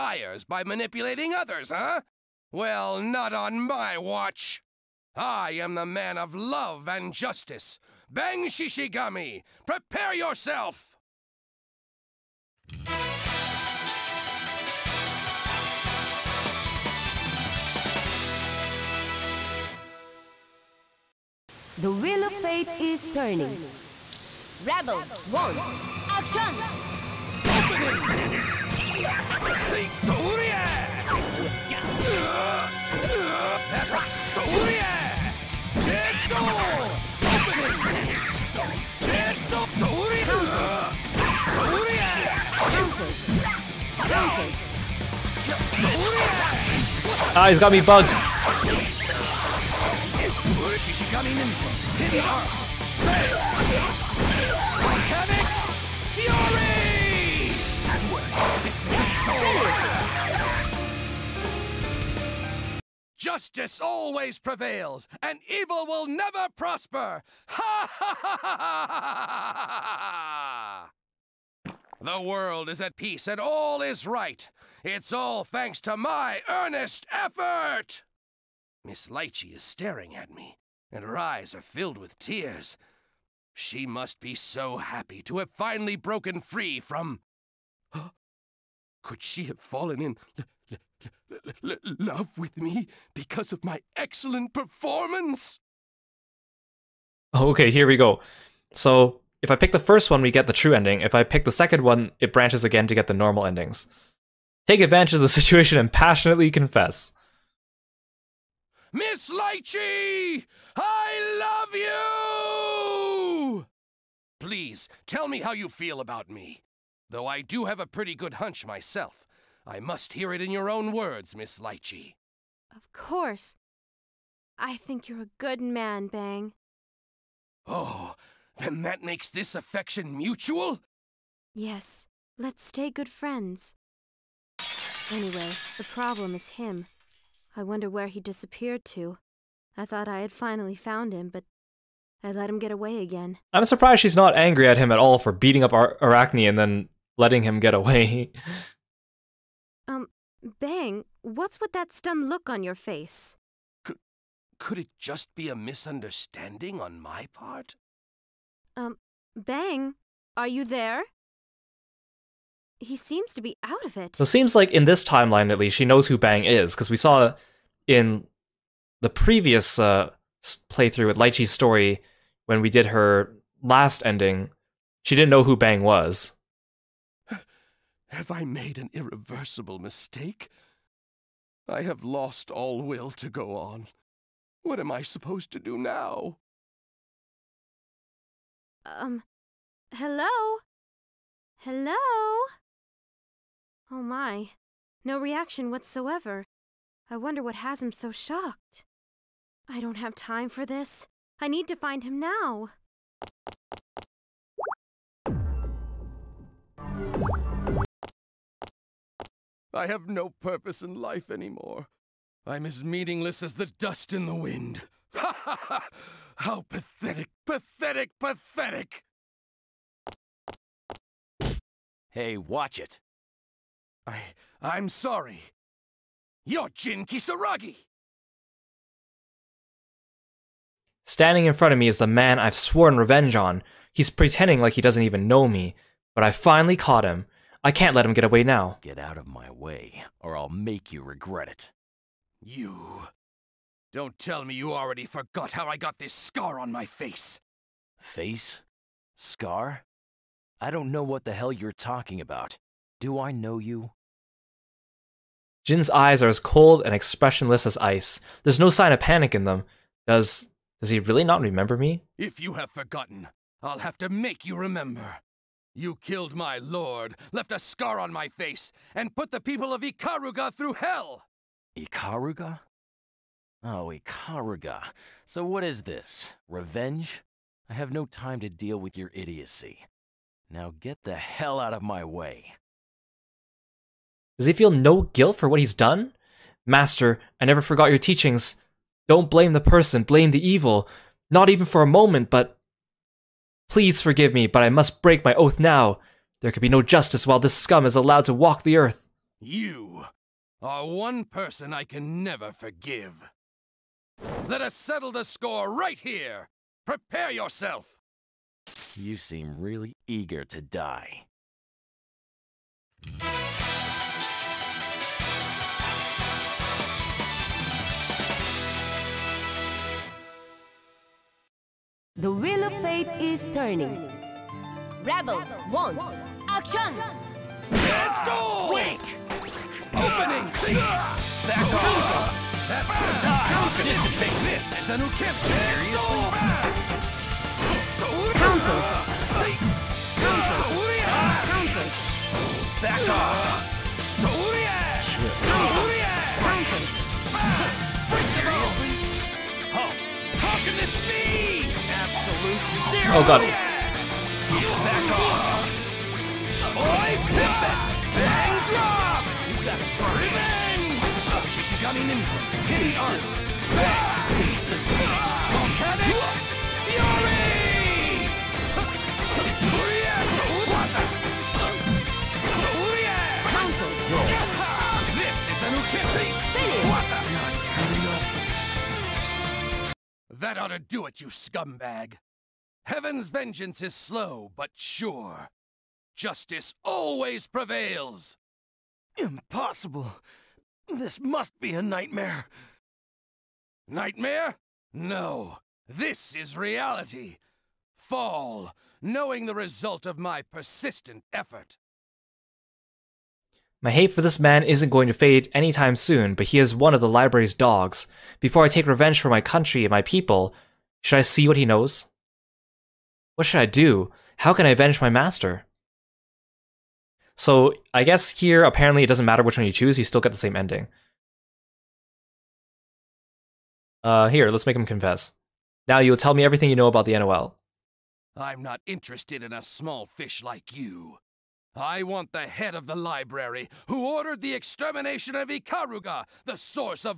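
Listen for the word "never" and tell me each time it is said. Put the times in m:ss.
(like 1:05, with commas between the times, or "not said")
1:06, 4:47, 5:02.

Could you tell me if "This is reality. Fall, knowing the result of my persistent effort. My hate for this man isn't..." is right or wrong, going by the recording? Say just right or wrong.
right.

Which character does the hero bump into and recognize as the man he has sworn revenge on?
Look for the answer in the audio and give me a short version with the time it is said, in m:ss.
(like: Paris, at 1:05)
Jin Kisaragi, at 3:46.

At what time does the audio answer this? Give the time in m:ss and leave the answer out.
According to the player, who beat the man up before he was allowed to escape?
2:25.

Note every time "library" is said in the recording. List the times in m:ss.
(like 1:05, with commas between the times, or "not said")
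6:47, 7:12.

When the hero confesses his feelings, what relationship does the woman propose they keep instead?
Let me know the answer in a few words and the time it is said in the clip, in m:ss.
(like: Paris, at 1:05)
good friends, at 2:12.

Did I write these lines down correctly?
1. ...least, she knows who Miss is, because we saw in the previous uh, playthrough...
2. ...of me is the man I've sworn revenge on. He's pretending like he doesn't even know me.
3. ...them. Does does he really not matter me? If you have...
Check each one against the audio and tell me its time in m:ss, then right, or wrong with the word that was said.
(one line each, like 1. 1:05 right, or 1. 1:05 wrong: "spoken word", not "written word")
1. 2:45 wrong: "Bang", not "Miss"
2. 3:51 right
3. 4:19 wrong: "remember", not "matter".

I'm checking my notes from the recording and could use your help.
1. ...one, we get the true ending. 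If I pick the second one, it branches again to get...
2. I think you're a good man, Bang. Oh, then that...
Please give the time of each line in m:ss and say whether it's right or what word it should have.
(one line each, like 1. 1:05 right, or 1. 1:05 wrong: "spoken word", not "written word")
1. 1:40 right
2. 2:04 right.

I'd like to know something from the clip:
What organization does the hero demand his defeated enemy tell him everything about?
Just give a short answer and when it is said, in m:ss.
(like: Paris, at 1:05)
NOL, at 7:07.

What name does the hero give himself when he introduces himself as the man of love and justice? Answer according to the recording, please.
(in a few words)
Bang Shishigami.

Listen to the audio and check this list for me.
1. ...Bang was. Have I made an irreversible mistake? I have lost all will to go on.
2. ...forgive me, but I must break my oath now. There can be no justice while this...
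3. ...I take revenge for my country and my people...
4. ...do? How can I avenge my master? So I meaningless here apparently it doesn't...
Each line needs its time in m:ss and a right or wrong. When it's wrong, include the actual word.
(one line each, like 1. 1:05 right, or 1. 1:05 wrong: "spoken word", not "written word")
1. 2:55 right
2. 4:54 right
3. 6:48 right
4. 6:53 wrong: "guess", not "meaningless".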